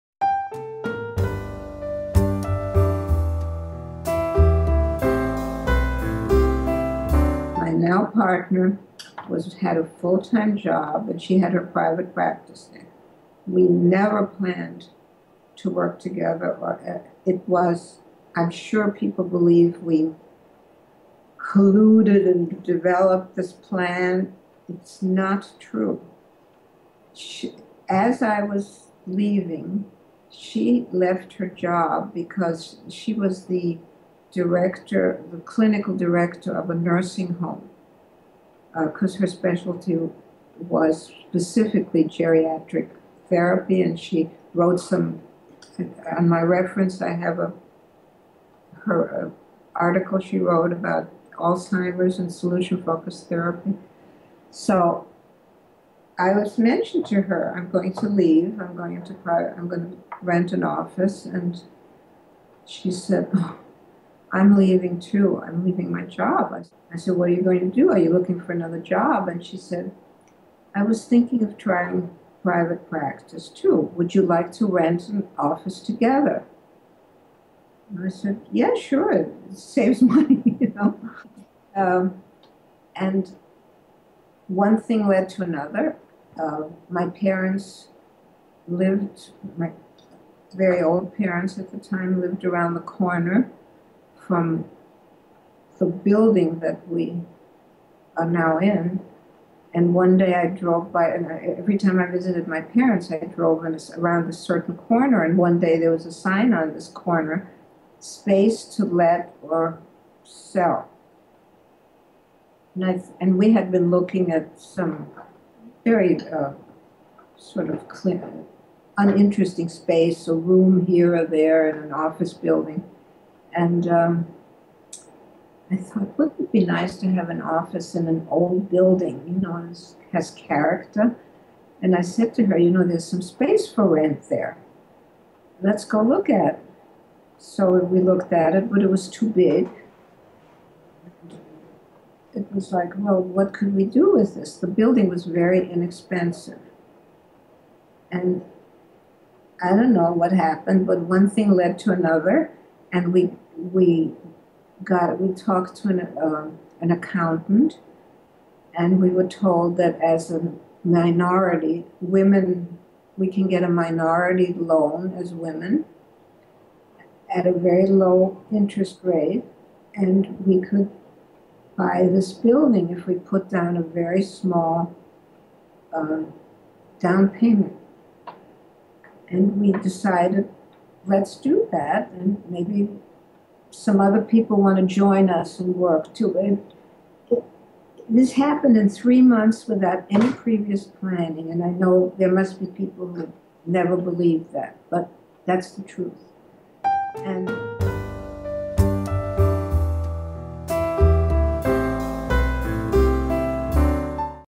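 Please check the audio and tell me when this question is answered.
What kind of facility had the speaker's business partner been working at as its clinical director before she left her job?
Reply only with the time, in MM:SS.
00:36.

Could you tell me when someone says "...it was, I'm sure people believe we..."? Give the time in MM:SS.
00:17.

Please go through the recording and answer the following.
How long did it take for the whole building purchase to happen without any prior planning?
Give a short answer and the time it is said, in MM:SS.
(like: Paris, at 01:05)
3 months, at 03:08.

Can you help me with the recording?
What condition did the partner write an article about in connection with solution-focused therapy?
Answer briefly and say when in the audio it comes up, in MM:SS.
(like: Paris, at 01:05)
Alzheimer's, at 00:51.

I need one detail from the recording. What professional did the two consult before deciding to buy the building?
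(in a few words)
an accountant.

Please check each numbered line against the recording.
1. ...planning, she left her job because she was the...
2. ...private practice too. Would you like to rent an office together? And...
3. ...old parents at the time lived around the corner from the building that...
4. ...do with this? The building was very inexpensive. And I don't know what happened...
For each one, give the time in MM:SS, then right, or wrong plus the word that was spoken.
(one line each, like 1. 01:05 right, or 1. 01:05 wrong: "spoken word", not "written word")
1. 00:29 wrong: "leaving", not "planning"
2. 01:12 right
3. 01:30 right
4. 02:23 right.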